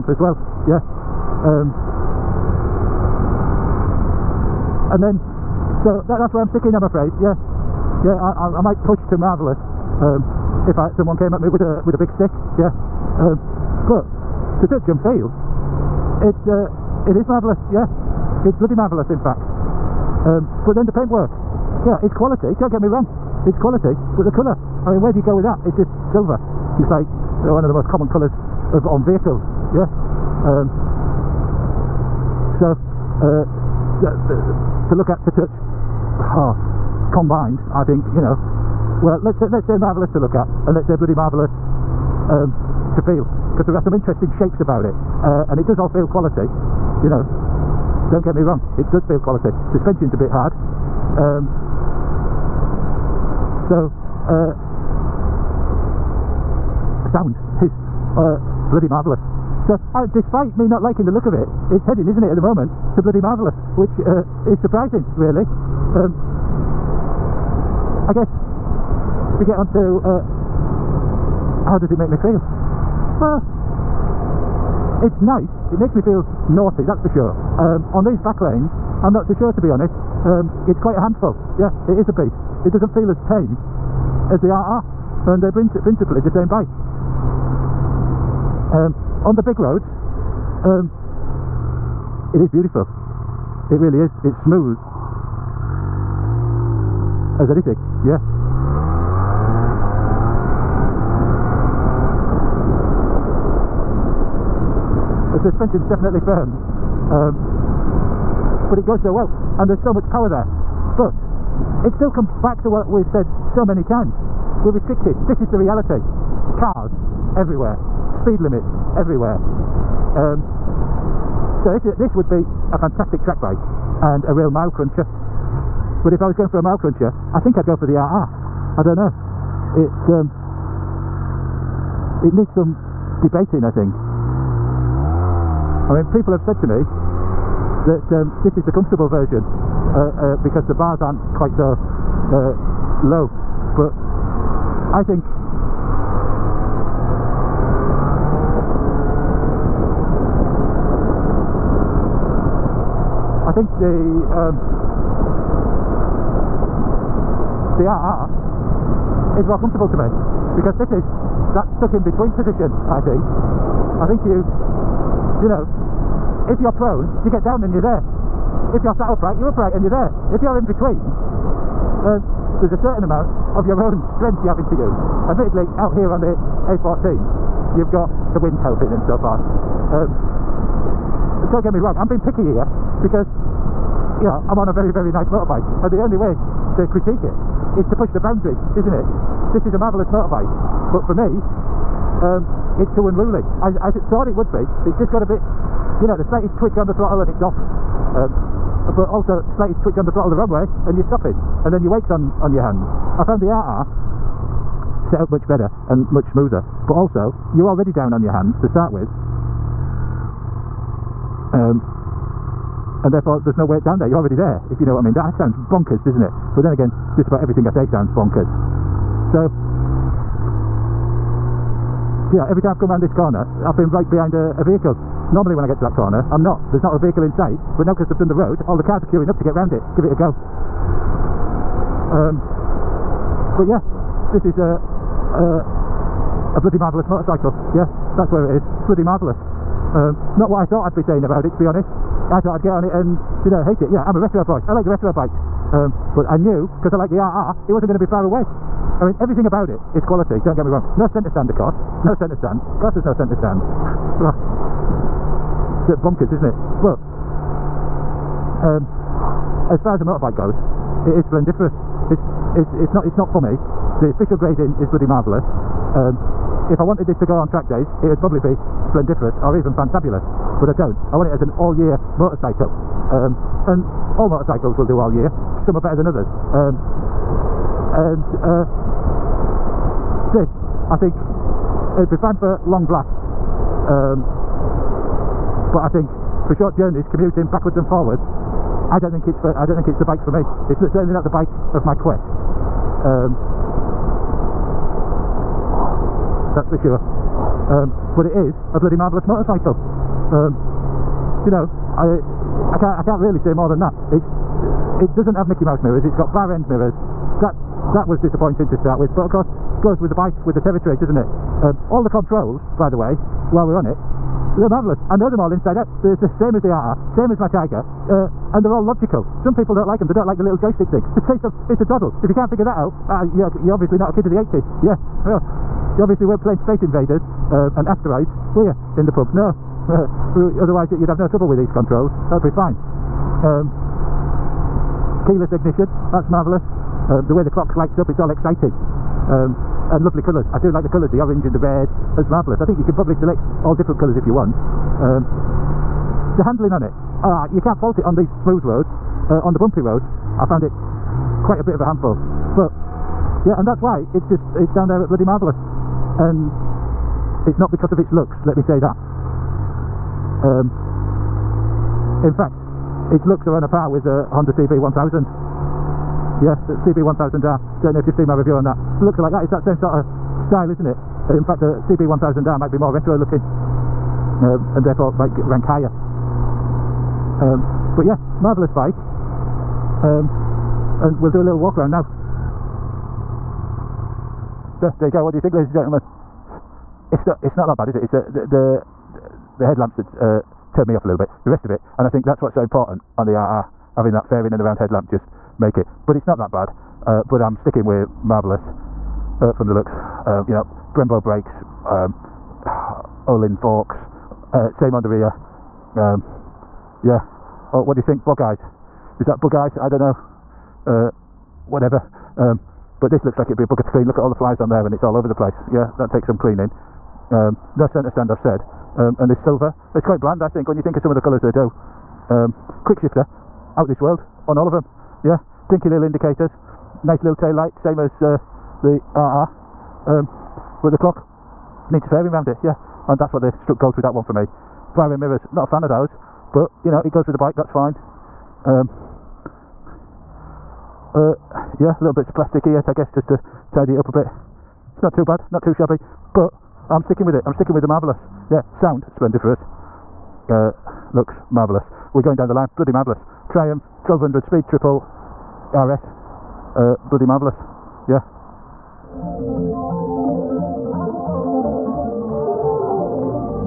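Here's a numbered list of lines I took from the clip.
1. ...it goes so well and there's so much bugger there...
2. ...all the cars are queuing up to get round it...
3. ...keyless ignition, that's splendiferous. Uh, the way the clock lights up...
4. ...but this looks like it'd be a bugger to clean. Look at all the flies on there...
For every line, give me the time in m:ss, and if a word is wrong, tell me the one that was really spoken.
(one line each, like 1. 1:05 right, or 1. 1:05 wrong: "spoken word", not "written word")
1. 1:48 wrong: "power", not "bugger"
2. 3:48 right
3. 5:35 wrong: "marvellous", not "splendiferous"
4. 6:52 right.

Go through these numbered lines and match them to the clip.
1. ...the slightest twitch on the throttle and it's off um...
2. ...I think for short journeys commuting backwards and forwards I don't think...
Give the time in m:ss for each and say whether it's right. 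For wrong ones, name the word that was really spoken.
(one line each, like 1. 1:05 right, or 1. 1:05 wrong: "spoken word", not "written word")
1. 3:16 right
2. 4:45 right.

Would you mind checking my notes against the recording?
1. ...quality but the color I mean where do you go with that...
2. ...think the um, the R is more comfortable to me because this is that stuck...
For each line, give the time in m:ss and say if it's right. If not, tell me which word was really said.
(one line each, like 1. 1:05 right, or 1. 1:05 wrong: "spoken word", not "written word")
1. 0:23 right
2. 2:33 right.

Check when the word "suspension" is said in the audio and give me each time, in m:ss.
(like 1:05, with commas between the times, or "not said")
0:49, 1:45.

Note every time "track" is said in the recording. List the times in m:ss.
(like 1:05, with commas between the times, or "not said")
2:03, 4:27.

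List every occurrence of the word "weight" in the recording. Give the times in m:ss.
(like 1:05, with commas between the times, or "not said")
3:21.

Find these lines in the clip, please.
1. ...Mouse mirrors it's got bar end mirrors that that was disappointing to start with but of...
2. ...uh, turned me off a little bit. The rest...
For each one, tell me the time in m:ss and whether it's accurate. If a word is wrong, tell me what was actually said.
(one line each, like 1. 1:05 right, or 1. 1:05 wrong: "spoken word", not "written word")
1. 5:05 right
2. 6:30 right.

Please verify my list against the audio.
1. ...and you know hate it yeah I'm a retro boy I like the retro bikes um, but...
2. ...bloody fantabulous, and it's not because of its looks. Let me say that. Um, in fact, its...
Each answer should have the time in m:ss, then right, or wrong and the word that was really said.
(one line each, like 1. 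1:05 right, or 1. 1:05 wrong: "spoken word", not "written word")
1. 4:02 right
2. 5:55 wrong: "marvelous", not "fantabulous".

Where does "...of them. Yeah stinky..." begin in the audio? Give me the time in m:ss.
7:04.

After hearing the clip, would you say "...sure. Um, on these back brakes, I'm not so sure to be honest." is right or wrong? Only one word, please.
wrong.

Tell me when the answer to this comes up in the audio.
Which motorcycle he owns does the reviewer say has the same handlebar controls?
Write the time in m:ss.
5:17.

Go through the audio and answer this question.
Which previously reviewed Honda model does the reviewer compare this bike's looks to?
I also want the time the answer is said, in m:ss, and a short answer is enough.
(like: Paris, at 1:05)
Honda CB1000R, at 6:06.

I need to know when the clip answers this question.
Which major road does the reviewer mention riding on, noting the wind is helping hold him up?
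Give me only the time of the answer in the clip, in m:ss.
2:56.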